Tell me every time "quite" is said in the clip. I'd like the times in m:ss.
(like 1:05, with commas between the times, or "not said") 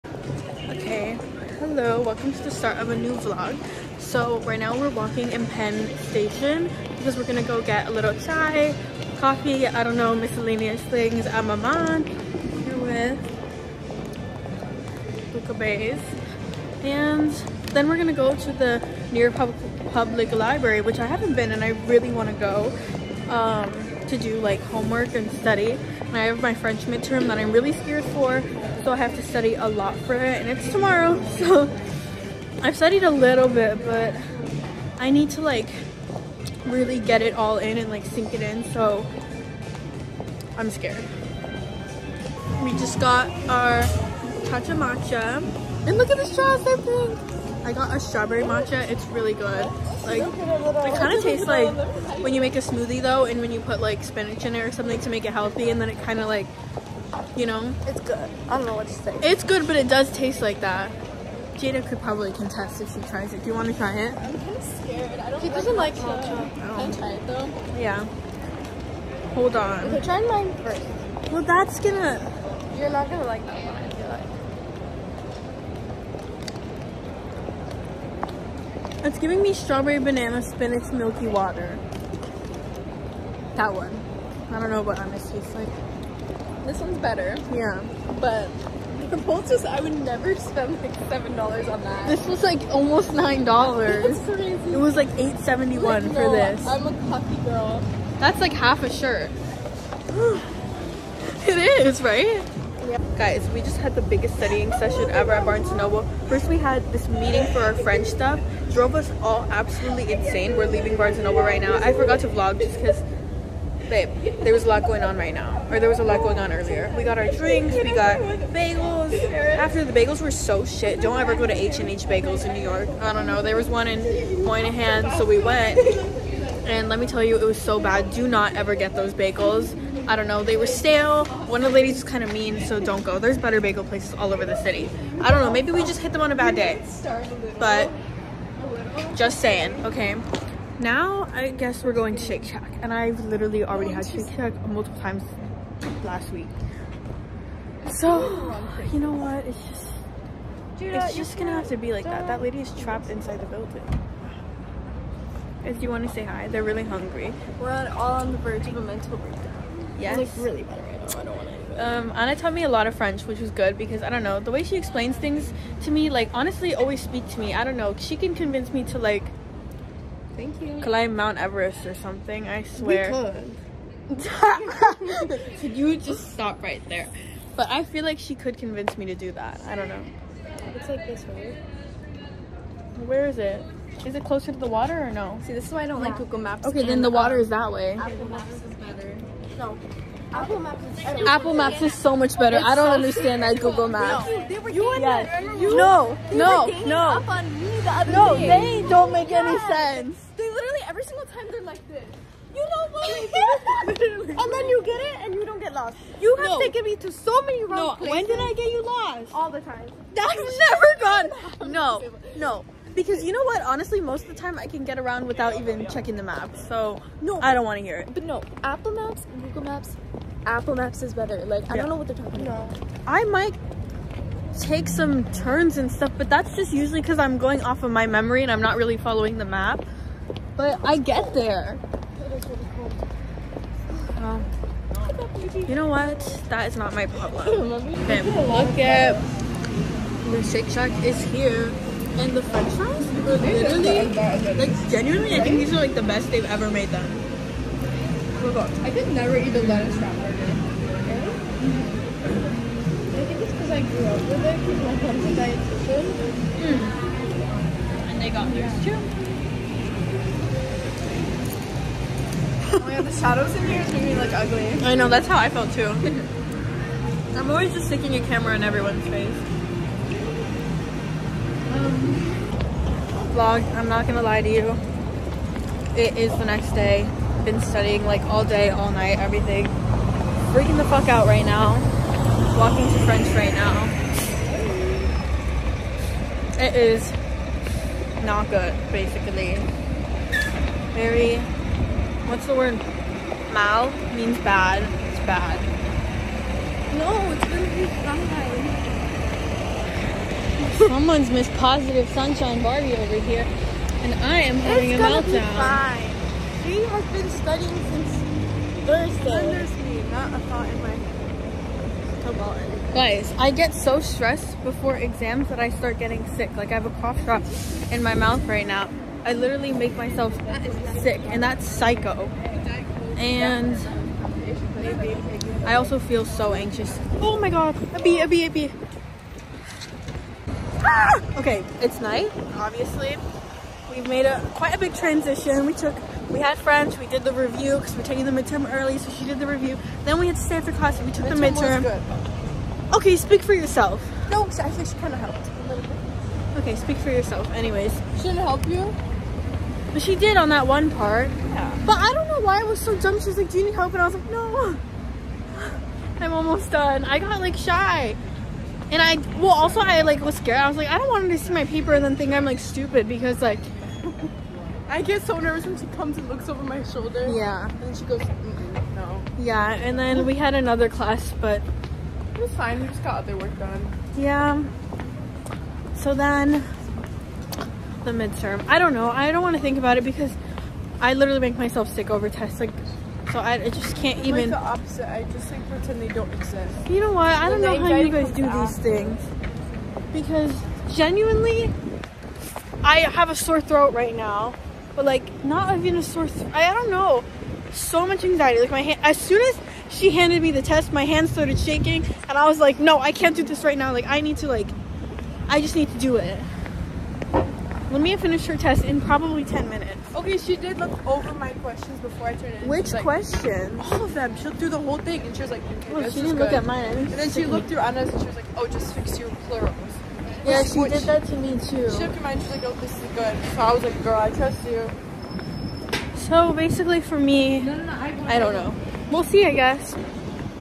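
5:34.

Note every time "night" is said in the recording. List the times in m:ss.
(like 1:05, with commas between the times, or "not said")
4:38, 5:32.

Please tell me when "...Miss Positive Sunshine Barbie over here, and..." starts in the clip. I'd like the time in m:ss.
5:01.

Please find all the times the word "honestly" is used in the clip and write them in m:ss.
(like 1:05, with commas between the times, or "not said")
2:46, 3:33.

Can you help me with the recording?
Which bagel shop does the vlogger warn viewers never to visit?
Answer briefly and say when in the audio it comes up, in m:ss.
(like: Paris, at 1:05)
H&H Bagels, at 2:01.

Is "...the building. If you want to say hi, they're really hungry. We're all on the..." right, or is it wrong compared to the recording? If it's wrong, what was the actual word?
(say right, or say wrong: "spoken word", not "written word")
right.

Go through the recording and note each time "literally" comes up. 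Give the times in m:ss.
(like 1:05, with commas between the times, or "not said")
2:23, 3:20, 4:03, 5:19, 6:21.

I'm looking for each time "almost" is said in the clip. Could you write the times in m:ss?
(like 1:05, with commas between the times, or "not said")
1:32, 5:56.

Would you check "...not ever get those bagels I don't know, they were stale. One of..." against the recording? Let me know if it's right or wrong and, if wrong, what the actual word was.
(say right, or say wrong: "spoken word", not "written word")
right.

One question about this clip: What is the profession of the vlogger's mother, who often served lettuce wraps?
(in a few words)
Dietitian.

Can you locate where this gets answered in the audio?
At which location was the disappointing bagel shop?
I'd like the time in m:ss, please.
2:04.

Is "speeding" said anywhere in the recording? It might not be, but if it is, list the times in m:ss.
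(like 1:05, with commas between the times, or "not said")
not said.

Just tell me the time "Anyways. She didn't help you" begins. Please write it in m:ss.
5:47.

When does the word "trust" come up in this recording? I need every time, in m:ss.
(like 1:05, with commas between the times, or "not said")
7:04.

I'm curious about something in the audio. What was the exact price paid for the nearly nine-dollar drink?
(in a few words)
$8.71.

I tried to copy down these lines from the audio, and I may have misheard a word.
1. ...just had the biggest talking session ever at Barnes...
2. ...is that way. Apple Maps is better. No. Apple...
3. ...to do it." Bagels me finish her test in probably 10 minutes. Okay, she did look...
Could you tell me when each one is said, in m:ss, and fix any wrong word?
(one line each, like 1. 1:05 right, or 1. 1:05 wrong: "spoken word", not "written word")
1. 1:43 wrong: "studying", not "talking"
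2. 3:07 right
3. 6:45 wrong: "Let", not "Bagels".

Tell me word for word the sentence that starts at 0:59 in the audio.
It's good, but it does taste like that.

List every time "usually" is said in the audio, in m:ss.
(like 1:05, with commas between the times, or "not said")
3:46.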